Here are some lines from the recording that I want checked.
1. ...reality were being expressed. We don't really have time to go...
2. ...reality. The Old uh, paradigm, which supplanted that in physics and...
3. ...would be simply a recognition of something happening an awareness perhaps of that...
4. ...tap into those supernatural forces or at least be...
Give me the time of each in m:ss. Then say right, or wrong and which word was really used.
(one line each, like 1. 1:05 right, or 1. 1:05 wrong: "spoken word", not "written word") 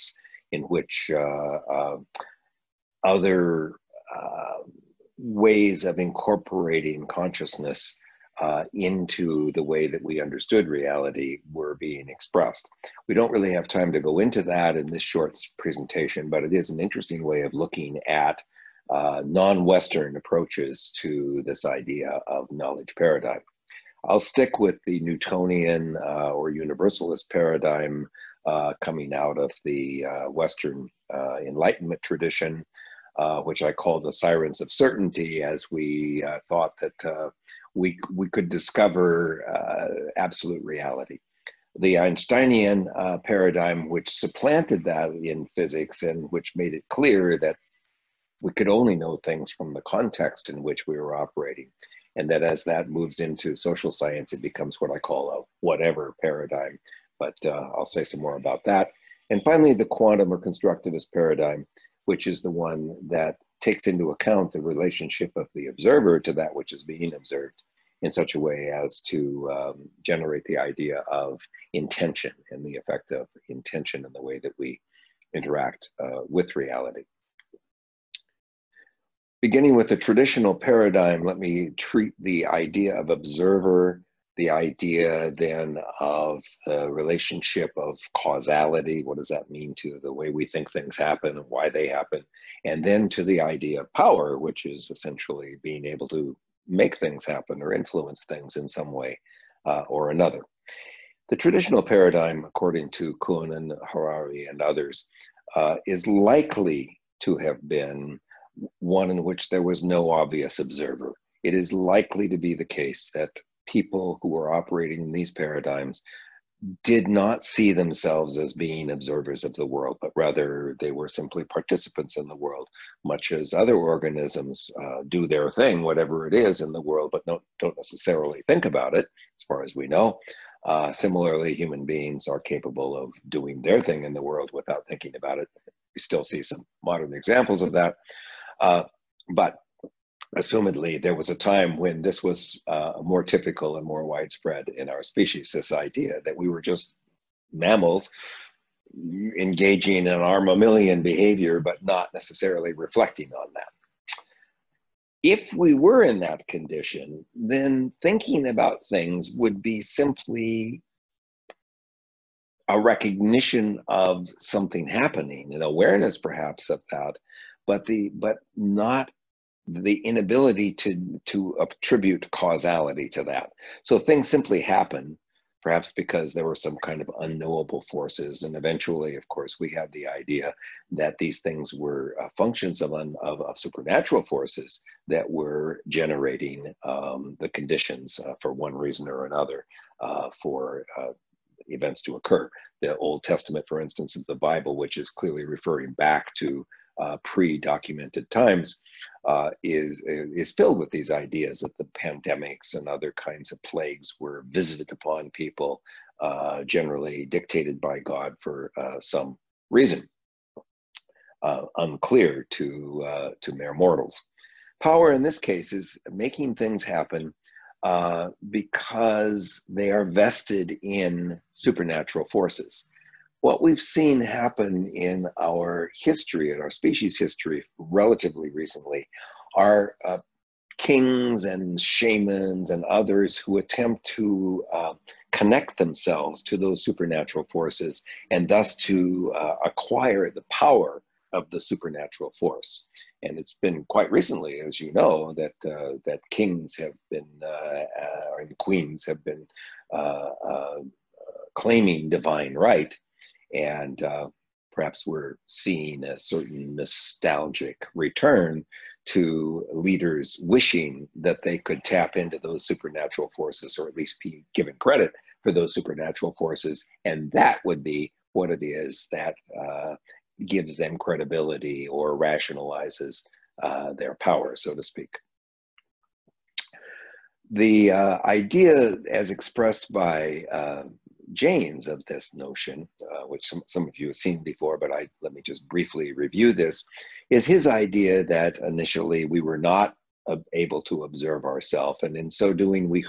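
1. 0:10 right
2. 0:40 wrong: "Einsteinian", not "Old"
3. 2:39 right
4. 4:21 right.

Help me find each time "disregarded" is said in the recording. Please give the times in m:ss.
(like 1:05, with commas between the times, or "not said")
not said.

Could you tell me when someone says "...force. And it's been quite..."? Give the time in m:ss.
4:02.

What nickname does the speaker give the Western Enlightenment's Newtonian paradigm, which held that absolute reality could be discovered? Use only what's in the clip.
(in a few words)
sirens of certainty.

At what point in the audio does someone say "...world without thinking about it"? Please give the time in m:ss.
2:14.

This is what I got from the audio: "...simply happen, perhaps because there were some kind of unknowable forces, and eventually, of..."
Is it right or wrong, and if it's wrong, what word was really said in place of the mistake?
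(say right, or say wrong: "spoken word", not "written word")
right.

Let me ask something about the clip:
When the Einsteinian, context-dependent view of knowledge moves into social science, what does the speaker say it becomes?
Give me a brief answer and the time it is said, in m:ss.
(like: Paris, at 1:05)
whatever paradigm, at 0:55.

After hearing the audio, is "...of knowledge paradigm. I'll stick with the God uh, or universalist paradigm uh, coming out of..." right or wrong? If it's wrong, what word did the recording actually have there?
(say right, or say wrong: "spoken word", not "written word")
wrong: "Newtonian", not "God".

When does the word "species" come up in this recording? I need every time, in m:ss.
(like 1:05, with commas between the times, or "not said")
2:25, 3:46.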